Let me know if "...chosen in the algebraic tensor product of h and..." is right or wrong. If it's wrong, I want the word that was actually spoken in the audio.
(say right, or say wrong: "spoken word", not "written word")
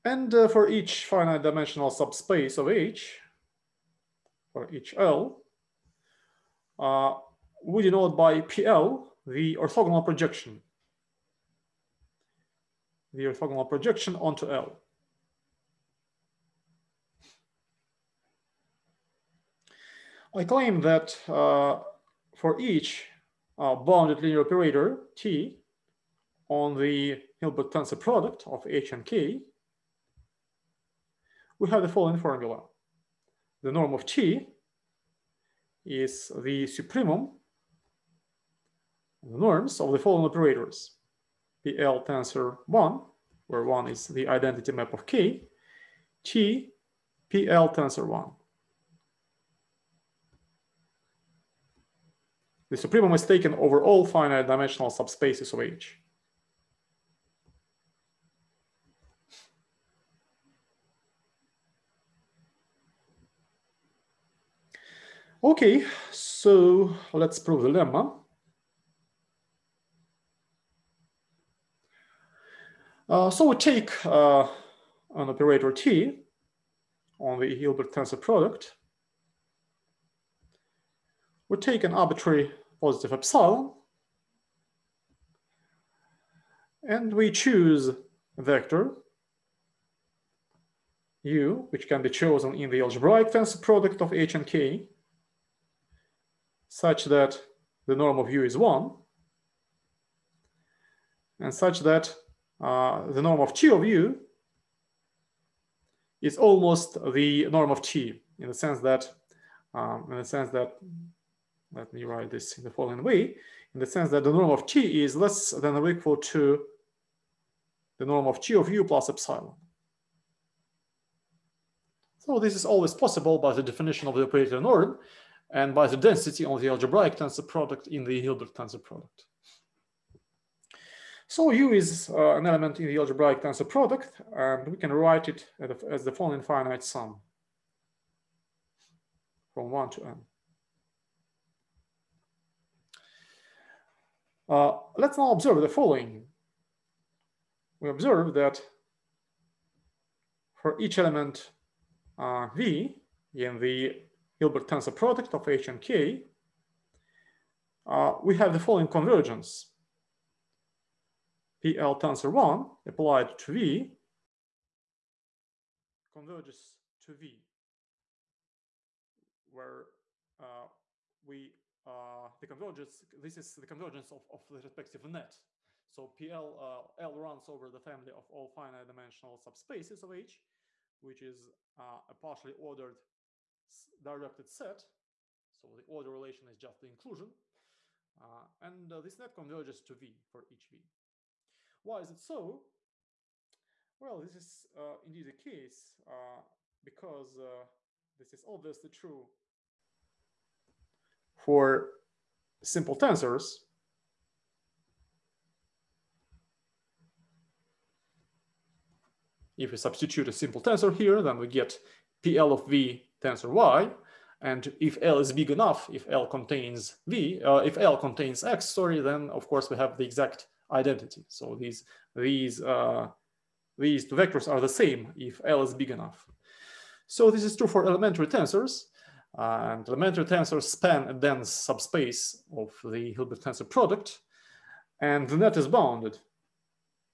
right.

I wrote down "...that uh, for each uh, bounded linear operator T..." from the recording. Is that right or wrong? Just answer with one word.
right.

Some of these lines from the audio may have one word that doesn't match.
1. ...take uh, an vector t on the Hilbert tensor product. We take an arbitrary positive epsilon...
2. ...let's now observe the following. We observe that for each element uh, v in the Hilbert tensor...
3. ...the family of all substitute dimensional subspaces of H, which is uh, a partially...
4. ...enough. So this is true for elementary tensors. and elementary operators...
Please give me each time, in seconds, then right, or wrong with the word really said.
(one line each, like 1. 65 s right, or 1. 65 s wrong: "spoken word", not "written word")
1. 73 s wrong: "operator", not "vector"
2. 144 s right
3. 177 s wrong: "finite", not "substitute"
4. 225 s wrong: "tensors", not "operators".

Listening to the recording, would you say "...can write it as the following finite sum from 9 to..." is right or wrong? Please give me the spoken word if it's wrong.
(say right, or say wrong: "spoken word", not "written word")
wrong: "1", not "9".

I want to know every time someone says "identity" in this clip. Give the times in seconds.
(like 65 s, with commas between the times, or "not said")
44 s, 220 s.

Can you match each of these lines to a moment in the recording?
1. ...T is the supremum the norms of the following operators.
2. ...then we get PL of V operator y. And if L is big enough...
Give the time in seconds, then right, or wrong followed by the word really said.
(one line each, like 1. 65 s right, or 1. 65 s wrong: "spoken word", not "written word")
1. 34 s right
2. 211 s wrong: "tensor", not "operator".